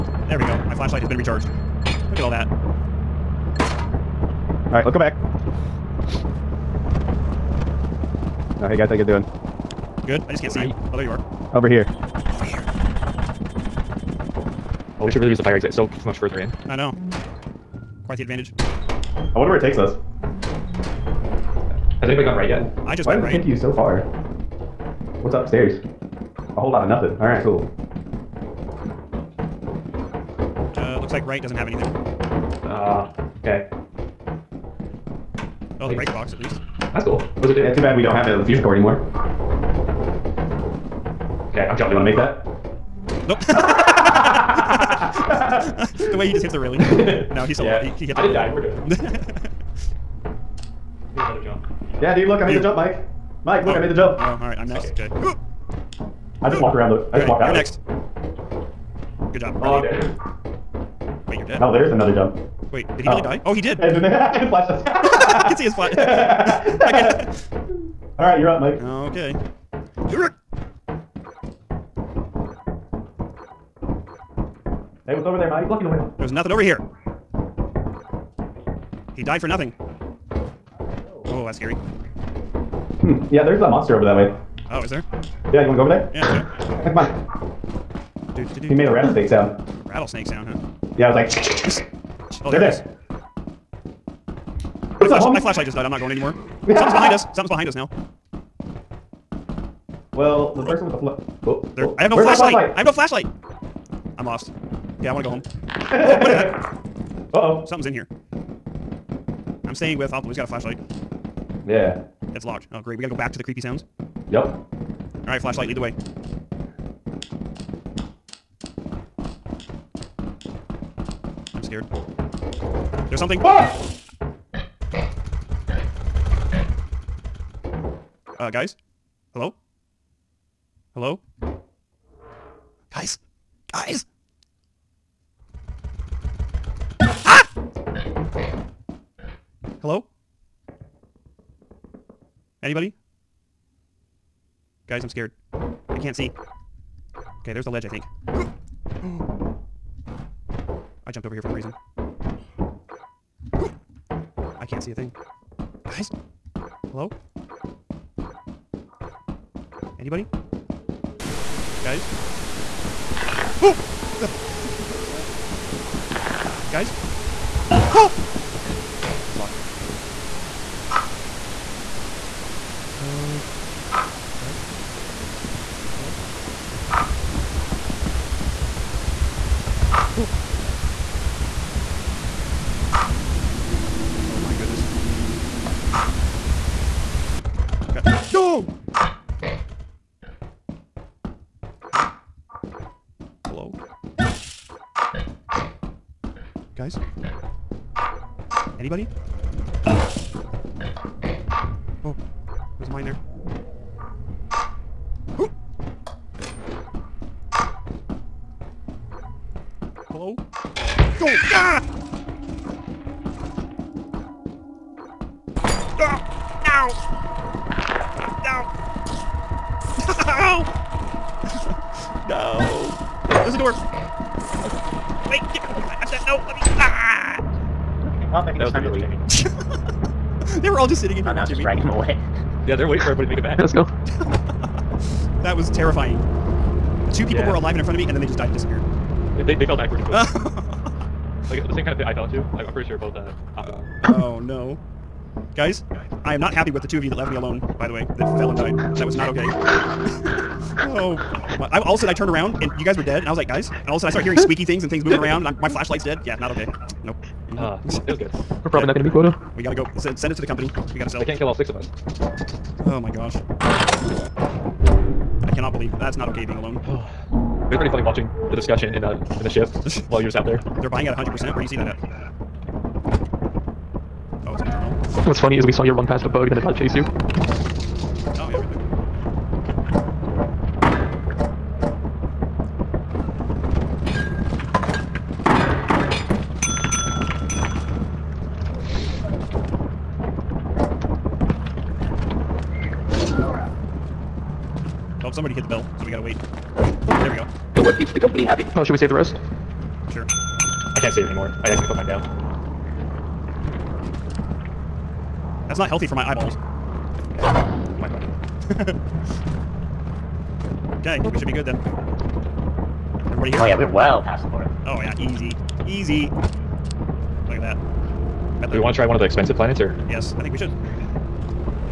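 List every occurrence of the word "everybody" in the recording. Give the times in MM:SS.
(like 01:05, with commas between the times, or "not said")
03:53, 05:13.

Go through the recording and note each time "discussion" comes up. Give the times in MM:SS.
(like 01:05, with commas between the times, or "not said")
04:28.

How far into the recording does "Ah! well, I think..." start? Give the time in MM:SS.
03:46.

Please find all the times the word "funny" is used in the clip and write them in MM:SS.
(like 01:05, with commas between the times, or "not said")
04:27, 04:35.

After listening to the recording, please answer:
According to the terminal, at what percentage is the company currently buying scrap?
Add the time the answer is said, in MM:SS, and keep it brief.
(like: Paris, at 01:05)
100%, at 04:31.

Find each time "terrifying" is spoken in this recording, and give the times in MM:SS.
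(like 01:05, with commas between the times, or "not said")
03:55.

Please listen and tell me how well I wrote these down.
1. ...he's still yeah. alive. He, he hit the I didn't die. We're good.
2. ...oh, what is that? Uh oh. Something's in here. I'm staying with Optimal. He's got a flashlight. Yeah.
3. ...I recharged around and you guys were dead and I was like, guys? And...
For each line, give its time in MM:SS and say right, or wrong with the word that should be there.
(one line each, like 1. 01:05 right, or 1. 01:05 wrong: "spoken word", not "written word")
1. 00:47 right
2. 01:45 right
3. 04:12 wrong: "turned", not "recharged".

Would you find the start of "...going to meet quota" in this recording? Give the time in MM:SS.
04:18.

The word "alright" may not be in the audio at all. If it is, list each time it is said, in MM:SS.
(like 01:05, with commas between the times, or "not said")
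00:04, 00:27, 00:54, 01:55.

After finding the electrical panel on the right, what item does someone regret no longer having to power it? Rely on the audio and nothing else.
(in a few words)
fusion core.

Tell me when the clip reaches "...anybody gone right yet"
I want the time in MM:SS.
00:22.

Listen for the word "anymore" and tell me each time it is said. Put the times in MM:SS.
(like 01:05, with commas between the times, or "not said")
00:38, 01:36, 05:01.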